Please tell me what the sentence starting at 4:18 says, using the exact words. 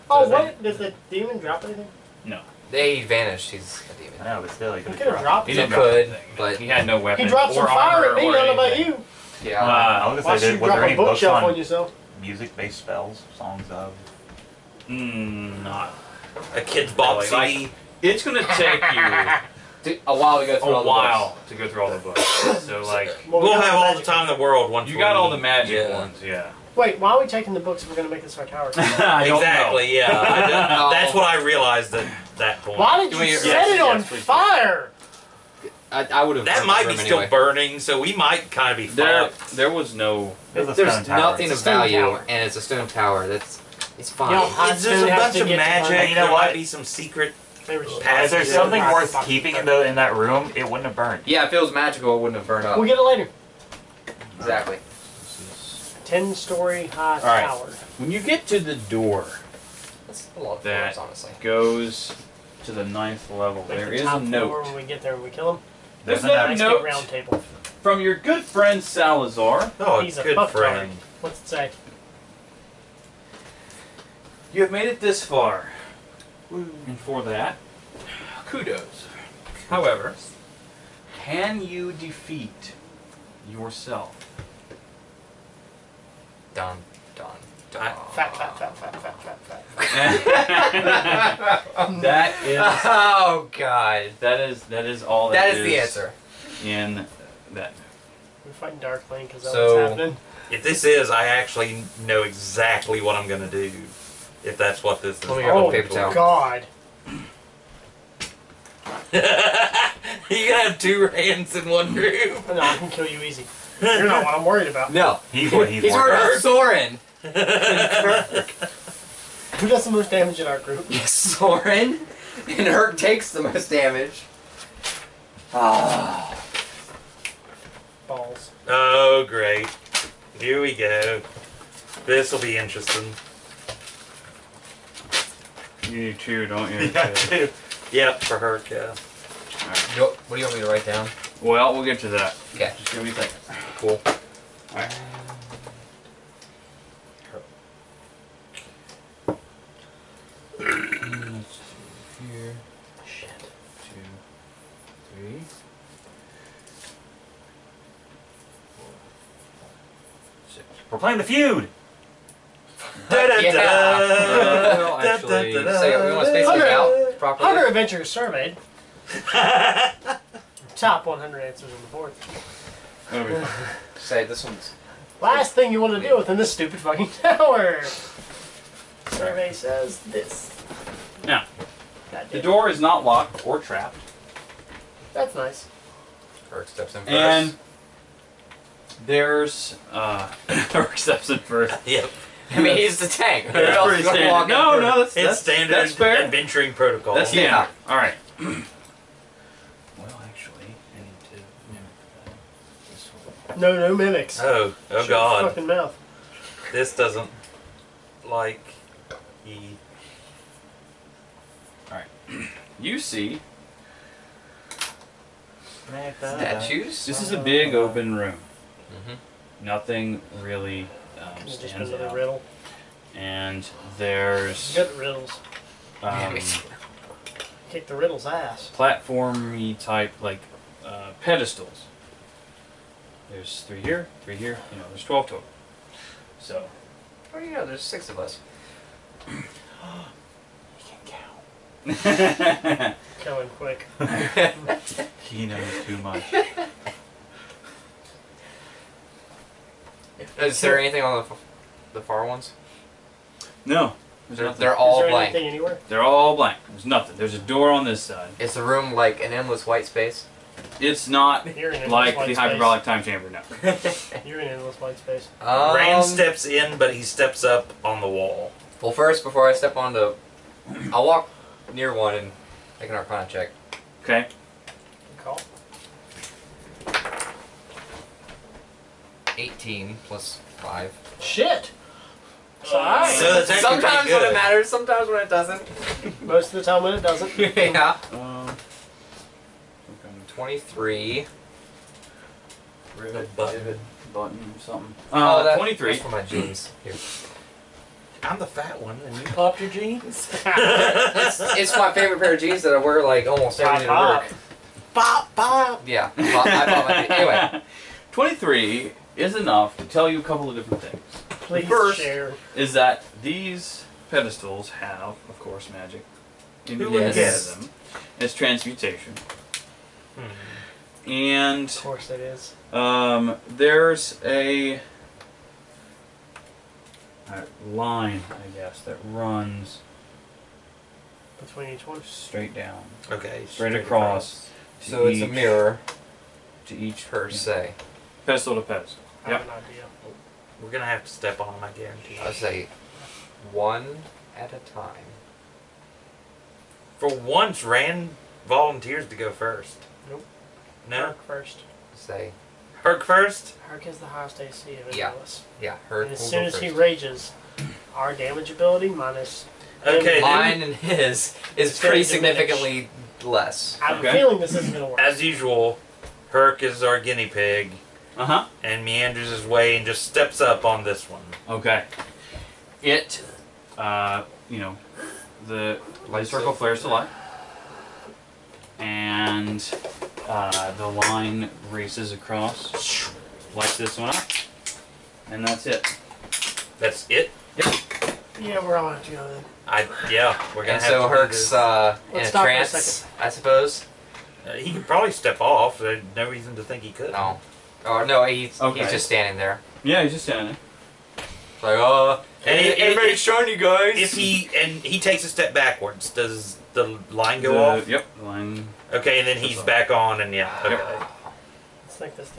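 Is the room like an endless white space?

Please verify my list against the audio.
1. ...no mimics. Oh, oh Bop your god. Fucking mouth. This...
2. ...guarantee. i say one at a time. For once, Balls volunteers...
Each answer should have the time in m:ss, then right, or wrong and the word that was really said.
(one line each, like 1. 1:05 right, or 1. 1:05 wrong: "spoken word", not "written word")
1. 3:23 wrong: "Shut", not "Bop"
2. 5:41 wrong: "Rand", not "Balls".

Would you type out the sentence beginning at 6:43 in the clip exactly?
If he and he takes a step backwards, does the line go the, off?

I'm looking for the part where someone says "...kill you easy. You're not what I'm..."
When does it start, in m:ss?
1:52.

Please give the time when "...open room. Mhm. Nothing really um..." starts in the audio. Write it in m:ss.
3:37.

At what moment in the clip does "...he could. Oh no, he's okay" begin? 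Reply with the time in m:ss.
6:36.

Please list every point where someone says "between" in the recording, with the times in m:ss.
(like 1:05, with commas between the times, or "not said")
5:31.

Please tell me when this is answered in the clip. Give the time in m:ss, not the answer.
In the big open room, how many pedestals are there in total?
3:55.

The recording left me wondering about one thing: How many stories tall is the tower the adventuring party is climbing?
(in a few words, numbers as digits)
10.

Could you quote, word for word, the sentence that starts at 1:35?
that, that is, is the answer.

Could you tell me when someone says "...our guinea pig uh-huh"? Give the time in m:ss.
6:06.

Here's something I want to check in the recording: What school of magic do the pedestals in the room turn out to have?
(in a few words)
Transmutation.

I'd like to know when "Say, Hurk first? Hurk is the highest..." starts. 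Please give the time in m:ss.
5:51.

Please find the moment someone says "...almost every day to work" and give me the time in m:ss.
5:03.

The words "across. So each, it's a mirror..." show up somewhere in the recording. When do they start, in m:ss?
5:34.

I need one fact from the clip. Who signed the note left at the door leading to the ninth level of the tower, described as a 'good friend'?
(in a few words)
Salazar.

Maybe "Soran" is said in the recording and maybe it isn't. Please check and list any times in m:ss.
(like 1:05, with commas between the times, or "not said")
1:56, 2:00.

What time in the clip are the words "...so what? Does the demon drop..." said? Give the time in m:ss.
0:00.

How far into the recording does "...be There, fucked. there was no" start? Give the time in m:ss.
0:38.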